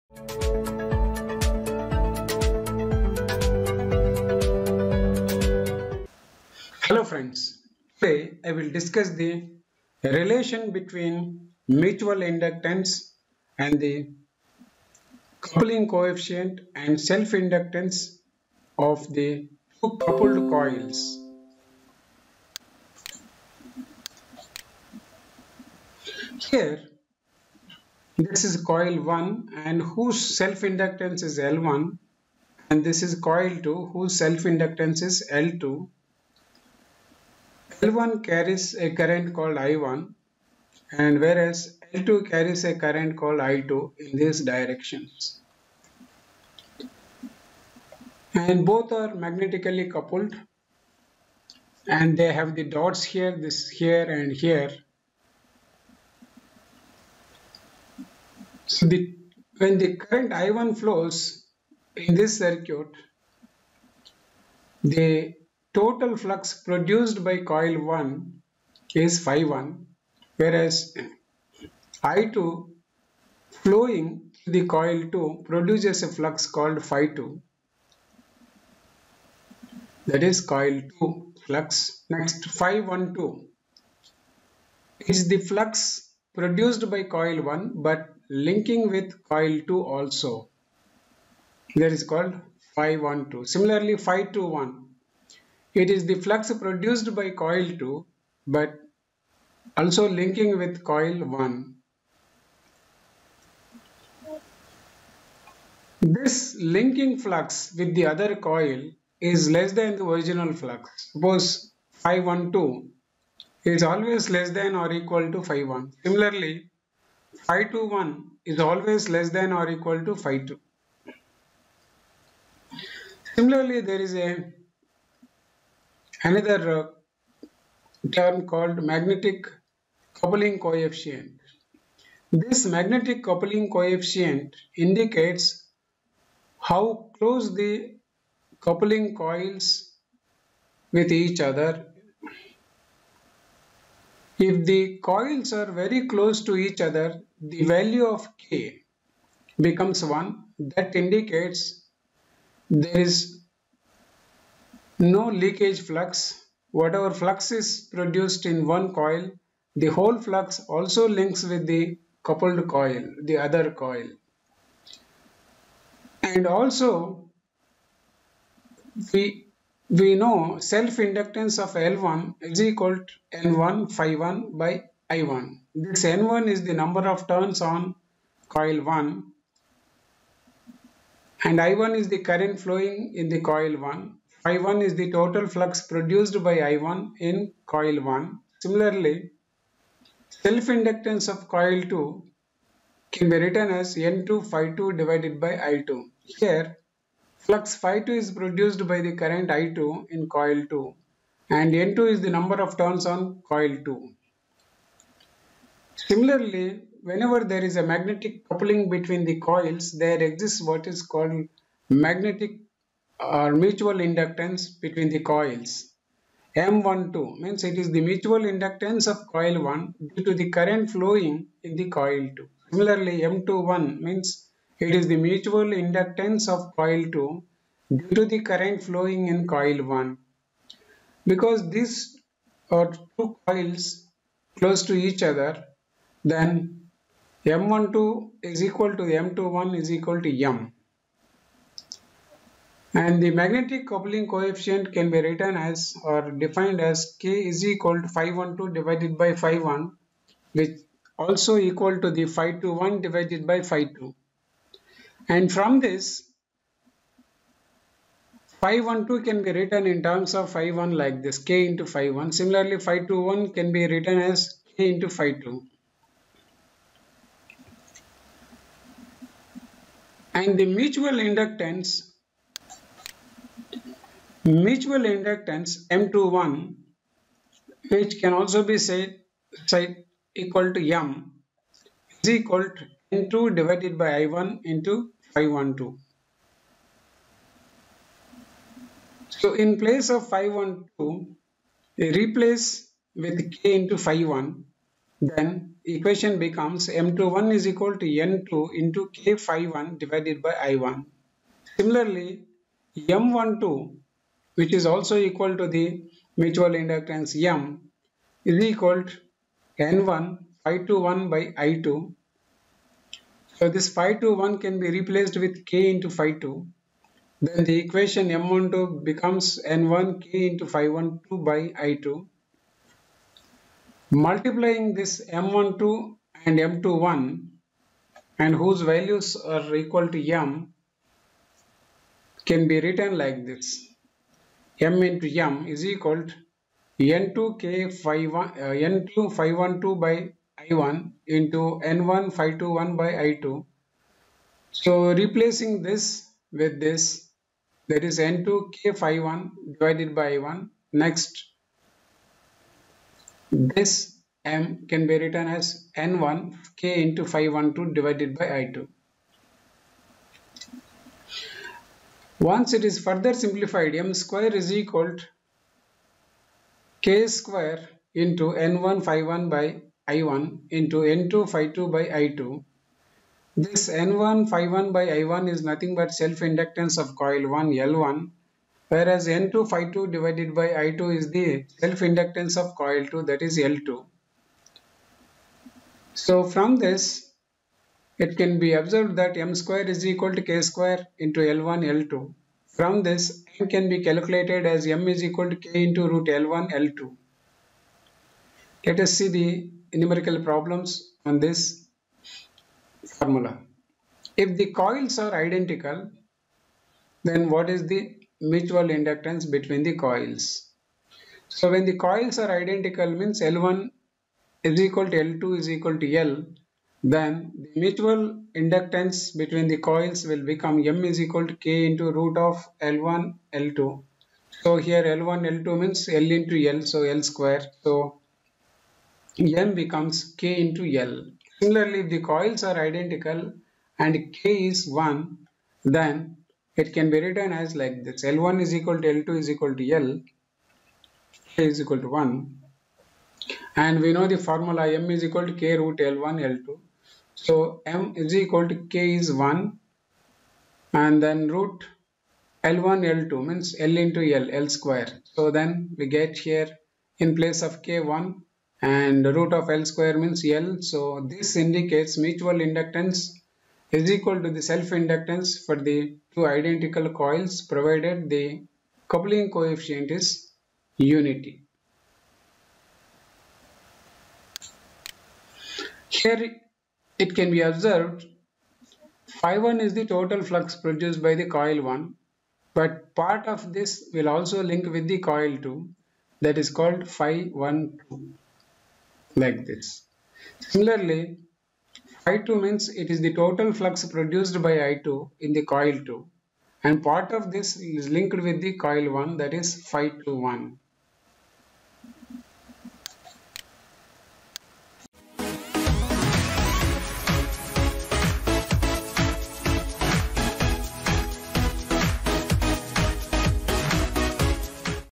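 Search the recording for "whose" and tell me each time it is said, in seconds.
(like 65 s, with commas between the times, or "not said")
29 s, 33 s, 328 s.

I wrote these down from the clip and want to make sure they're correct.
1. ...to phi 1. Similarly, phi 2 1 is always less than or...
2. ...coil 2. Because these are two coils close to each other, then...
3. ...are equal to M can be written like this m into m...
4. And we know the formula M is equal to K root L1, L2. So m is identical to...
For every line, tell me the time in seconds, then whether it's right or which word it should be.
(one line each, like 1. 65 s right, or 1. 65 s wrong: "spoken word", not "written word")
1. 115 s right
2. 229 s wrong: "1", not "2"
3. 329 s right
4. 443 s wrong: "equal", not "identical".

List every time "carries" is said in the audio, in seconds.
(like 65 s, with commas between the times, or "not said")
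38 s, 42 s.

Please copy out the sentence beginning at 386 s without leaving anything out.
So from this it can be observed that m square is equal to k square into L1, L2.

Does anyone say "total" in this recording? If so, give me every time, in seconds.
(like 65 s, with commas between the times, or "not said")
65 s, 185 s, 480 s, 493 s.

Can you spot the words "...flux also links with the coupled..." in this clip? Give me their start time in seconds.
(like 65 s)
160 s.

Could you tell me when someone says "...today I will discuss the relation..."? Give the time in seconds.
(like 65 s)
7 s.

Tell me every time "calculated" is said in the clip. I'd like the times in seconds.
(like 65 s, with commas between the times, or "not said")
394 s.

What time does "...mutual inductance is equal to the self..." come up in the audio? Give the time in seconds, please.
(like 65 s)
462 s.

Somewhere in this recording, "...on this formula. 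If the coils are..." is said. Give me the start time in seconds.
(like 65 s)
401 s.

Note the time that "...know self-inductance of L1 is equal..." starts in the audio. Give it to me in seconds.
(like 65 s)
170 s.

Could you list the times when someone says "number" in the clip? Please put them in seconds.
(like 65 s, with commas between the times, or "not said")
176 s, 202 s.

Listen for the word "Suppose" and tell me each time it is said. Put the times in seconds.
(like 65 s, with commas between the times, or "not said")
111 s.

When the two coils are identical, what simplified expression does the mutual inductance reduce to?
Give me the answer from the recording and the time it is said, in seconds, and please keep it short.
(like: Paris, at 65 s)
K into L, at 429 s.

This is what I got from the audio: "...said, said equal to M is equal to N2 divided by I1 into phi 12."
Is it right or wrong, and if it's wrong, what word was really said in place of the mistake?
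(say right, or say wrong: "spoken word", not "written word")
right.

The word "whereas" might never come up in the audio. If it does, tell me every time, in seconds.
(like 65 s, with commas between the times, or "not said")
41 s, 70 s, 378 s.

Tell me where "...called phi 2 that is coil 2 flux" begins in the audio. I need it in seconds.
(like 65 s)
76 s.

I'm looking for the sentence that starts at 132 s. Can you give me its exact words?
This magnetic coupling coefficient indicates how close the coupling coils with each other.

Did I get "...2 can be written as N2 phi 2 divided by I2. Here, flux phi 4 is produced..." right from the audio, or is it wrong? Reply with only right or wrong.
wrong.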